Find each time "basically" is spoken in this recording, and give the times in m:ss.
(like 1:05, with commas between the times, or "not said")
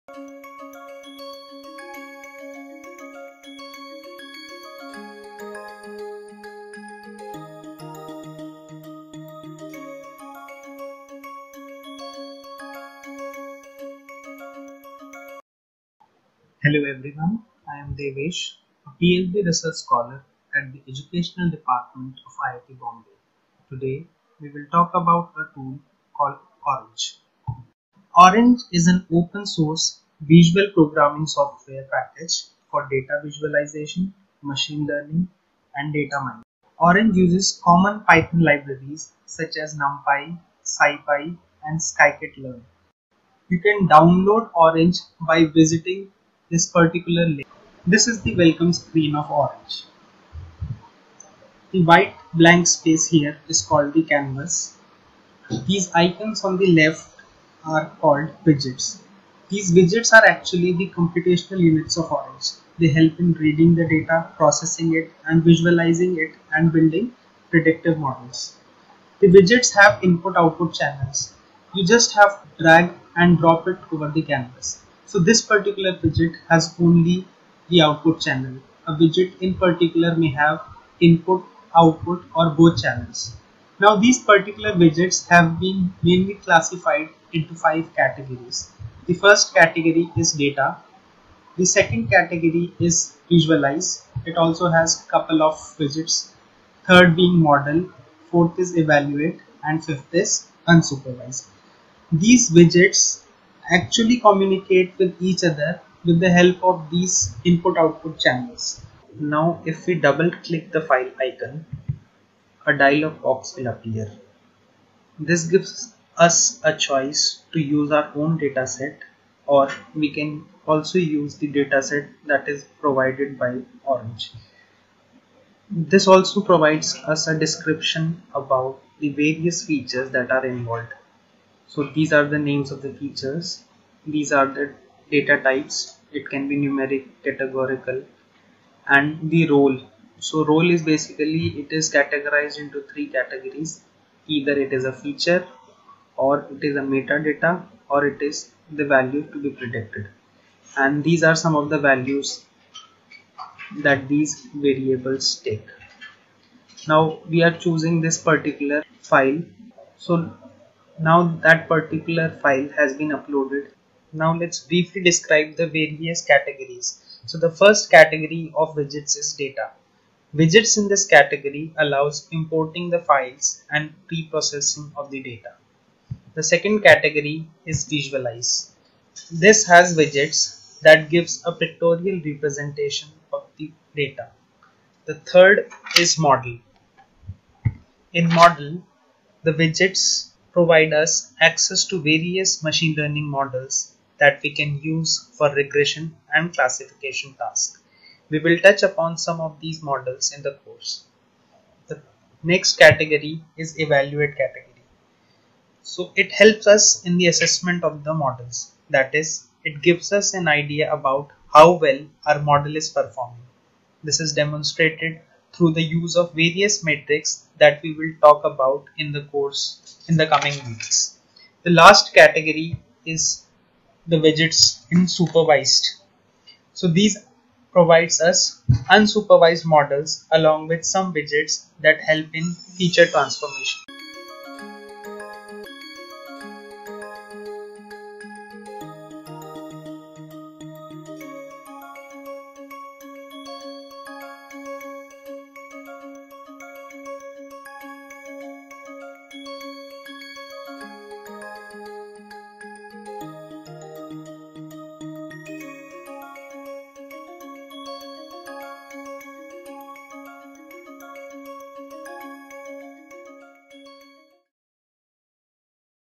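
2:20.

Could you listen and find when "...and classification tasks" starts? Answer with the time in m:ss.
3:16.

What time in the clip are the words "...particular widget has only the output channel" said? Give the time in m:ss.
1:15.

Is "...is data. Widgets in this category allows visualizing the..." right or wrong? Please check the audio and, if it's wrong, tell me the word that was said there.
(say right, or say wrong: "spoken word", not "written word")
wrong: "importing", not "visualizing".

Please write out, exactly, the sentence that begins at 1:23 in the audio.
Now these particular widgets have been mainly classified into five categories.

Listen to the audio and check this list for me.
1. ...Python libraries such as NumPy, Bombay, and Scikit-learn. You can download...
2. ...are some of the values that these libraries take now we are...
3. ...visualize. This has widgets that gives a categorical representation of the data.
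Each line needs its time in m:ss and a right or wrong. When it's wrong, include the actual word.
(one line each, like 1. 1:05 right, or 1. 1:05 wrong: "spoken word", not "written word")
1. 0:38 wrong: "SciPy", not "Bombay"
2. 2:31 wrong: "variables", not "libraries"
3. 2:57 wrong: "pictorial", not "categorical".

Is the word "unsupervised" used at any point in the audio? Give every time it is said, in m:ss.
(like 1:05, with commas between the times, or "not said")
1:40, 3:48.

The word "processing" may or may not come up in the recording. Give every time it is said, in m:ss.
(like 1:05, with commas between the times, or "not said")
1:04, 2:54.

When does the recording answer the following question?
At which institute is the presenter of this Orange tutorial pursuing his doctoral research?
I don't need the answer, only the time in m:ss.
0:22.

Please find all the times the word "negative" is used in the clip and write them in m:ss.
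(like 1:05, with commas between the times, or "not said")
not said.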